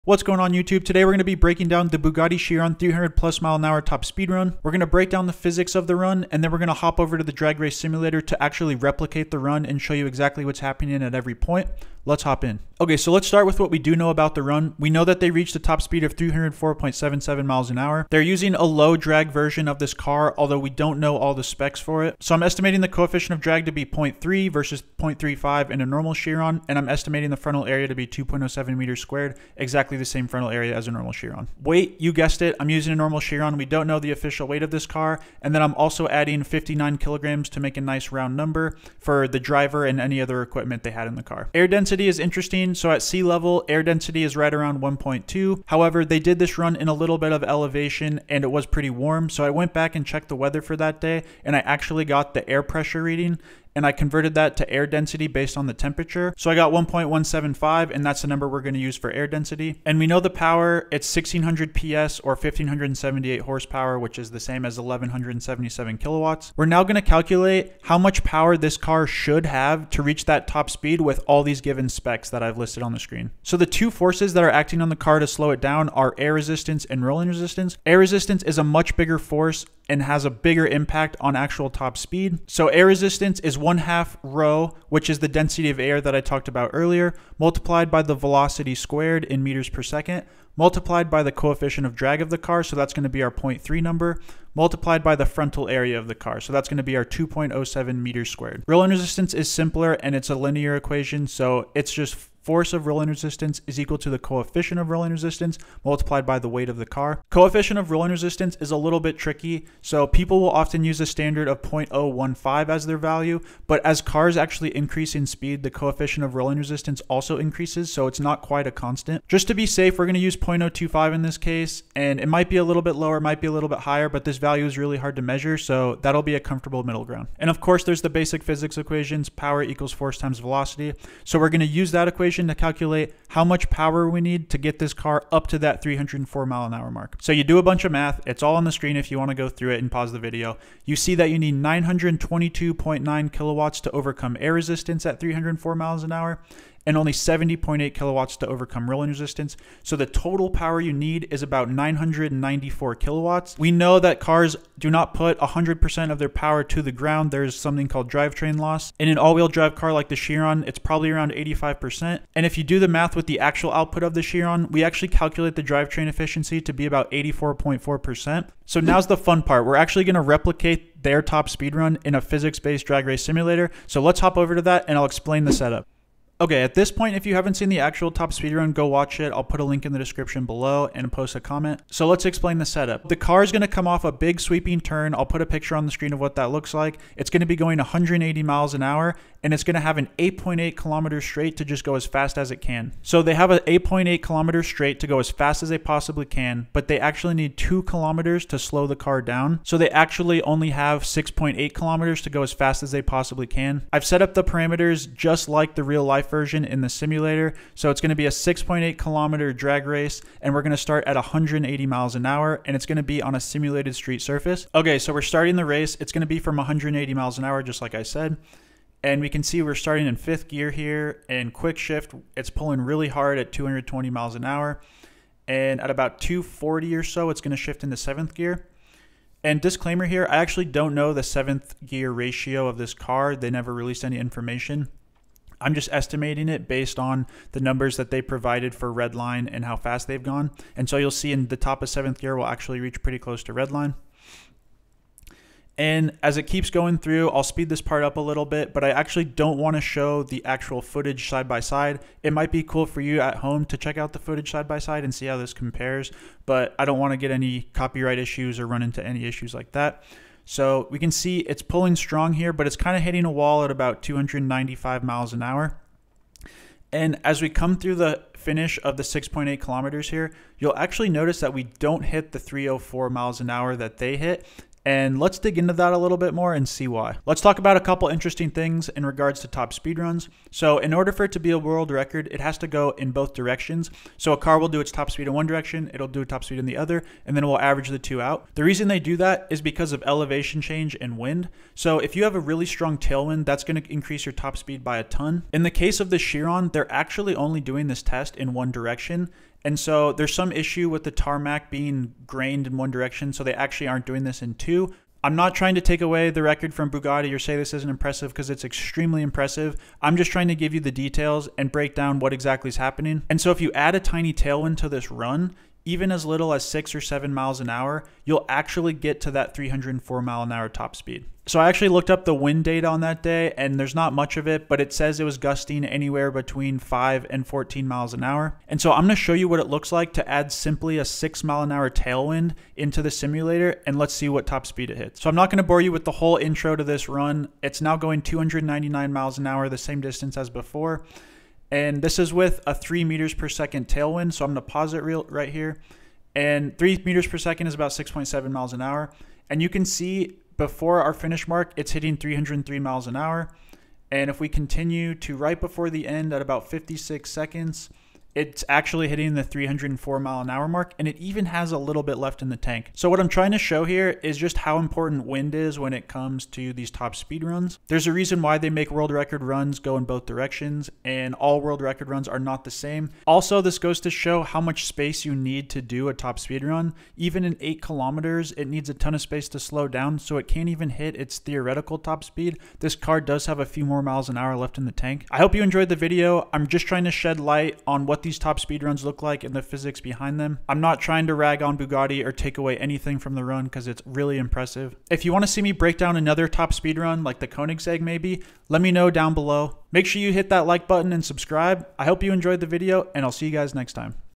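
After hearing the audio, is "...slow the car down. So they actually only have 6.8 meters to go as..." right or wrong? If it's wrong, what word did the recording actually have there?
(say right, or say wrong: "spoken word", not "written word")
wrong: "kilometers", not "meters".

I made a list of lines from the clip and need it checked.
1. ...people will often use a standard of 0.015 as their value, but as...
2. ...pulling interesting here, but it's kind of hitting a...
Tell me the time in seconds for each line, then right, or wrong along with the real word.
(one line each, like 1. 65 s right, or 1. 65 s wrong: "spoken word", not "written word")
1. 110 s right
2. 261 s wrong: "strong", not "interesting".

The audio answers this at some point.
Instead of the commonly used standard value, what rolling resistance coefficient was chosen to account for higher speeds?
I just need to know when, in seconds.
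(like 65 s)
120 s.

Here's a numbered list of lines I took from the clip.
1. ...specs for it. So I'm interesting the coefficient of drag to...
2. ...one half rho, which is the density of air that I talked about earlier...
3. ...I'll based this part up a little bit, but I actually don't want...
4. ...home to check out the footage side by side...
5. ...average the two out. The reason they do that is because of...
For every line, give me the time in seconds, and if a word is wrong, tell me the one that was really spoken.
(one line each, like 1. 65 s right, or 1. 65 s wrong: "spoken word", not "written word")
1. 21 s wrong: "estimating", not "interesting"
2. 83 s right
3. 247 s wrong: "speed", not "based"
4. 253 s right
5. 287 s right.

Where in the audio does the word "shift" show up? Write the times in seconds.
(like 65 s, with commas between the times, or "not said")
221 s, 227 s.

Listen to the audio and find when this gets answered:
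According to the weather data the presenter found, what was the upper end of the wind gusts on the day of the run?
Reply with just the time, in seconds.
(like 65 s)
327 s.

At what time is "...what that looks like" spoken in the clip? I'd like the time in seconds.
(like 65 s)
186 s.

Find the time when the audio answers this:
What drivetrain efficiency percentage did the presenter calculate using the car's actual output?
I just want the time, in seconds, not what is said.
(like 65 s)
167 s.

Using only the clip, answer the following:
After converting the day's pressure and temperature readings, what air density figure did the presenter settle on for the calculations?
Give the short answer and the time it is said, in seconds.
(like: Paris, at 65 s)
1.175, at 56 s.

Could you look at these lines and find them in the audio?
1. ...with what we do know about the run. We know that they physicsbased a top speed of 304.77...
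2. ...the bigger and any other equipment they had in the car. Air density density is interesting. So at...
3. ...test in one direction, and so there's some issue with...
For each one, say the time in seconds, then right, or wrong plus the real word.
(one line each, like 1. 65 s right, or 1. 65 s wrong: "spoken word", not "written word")
1. 13 s wrong: "reached", not "physicsbased"
2. 39 s wrong: "driver", not "bigger"
3. 298 s right.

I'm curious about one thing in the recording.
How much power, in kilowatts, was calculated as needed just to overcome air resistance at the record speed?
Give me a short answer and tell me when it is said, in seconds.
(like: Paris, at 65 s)
922.9 kilowatts, at 141 s.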